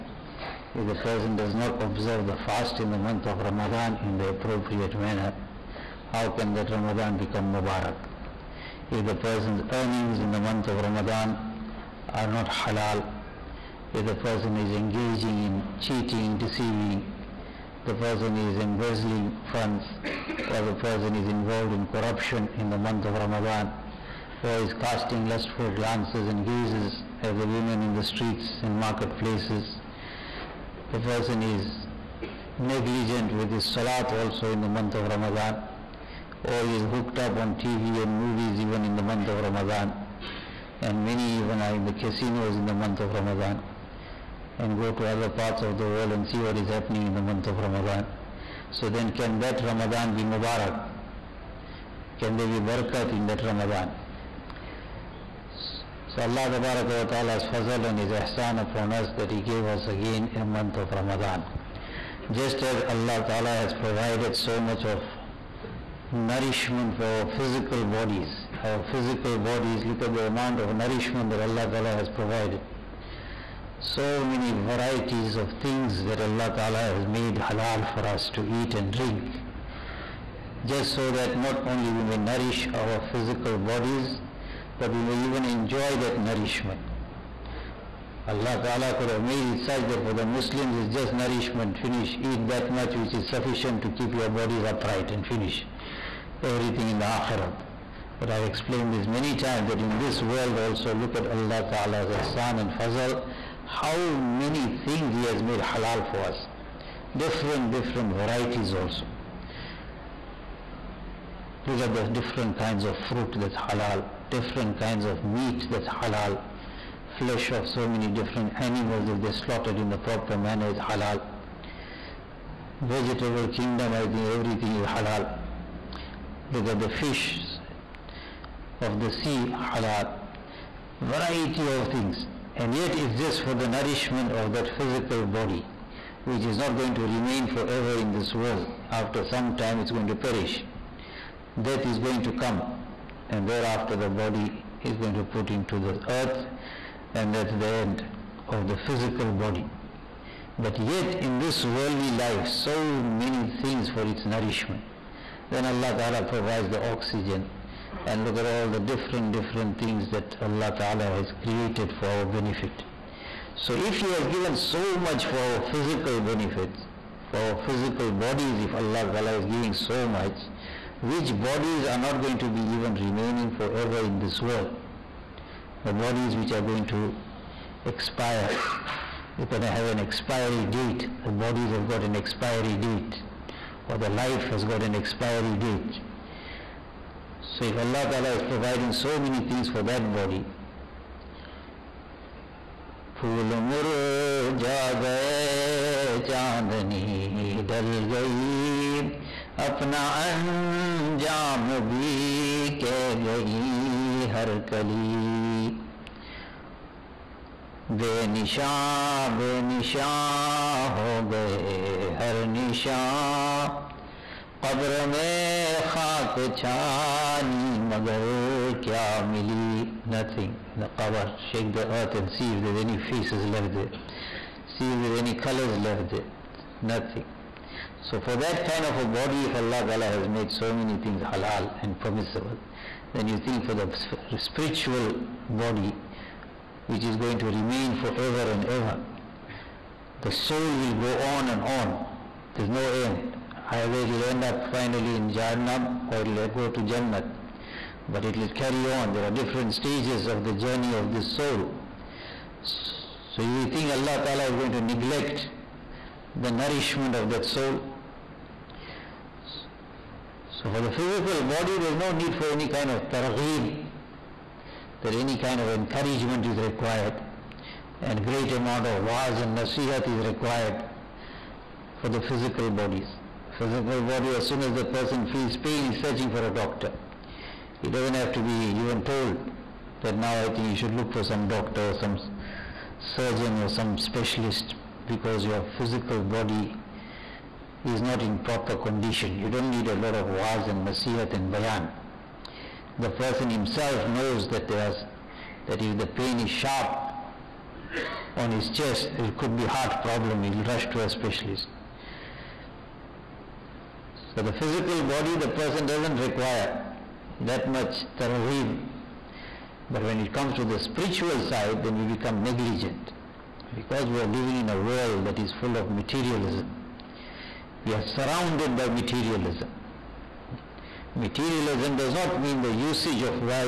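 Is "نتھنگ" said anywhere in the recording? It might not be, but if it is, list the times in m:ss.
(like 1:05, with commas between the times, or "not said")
3:40, 3:46.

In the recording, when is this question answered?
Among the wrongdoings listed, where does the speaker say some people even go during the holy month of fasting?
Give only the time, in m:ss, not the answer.
0:41.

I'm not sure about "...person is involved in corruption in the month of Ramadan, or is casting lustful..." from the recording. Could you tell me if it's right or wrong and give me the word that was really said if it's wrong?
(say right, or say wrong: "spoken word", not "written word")
right.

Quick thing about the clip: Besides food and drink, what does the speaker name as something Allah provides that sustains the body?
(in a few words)
oxygen.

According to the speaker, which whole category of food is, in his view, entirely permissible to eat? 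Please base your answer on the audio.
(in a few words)
Vegetable kingdom.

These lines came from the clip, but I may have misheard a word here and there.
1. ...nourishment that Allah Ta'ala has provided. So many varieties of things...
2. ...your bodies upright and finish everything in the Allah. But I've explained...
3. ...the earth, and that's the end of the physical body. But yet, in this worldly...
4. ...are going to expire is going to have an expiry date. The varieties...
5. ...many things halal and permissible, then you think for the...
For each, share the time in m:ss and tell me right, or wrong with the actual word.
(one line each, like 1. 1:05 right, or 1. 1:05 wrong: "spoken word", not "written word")
1. 1:10 right
2. 1:34 wrong: "Akhirat", not "Allah"
3. 2:25 right
4. 2:56 wrong: "bodies", not "varieties"
5. 3:50 right.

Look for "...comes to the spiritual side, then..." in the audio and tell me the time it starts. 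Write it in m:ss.
5:10.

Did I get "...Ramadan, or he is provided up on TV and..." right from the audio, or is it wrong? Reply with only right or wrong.
wrong.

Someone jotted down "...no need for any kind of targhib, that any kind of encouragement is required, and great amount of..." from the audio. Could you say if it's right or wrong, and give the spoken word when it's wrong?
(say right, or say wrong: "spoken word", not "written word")
right.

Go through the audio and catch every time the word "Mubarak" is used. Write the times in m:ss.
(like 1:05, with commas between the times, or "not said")
0:07, 0:50.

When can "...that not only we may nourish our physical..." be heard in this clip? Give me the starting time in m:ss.
1:21.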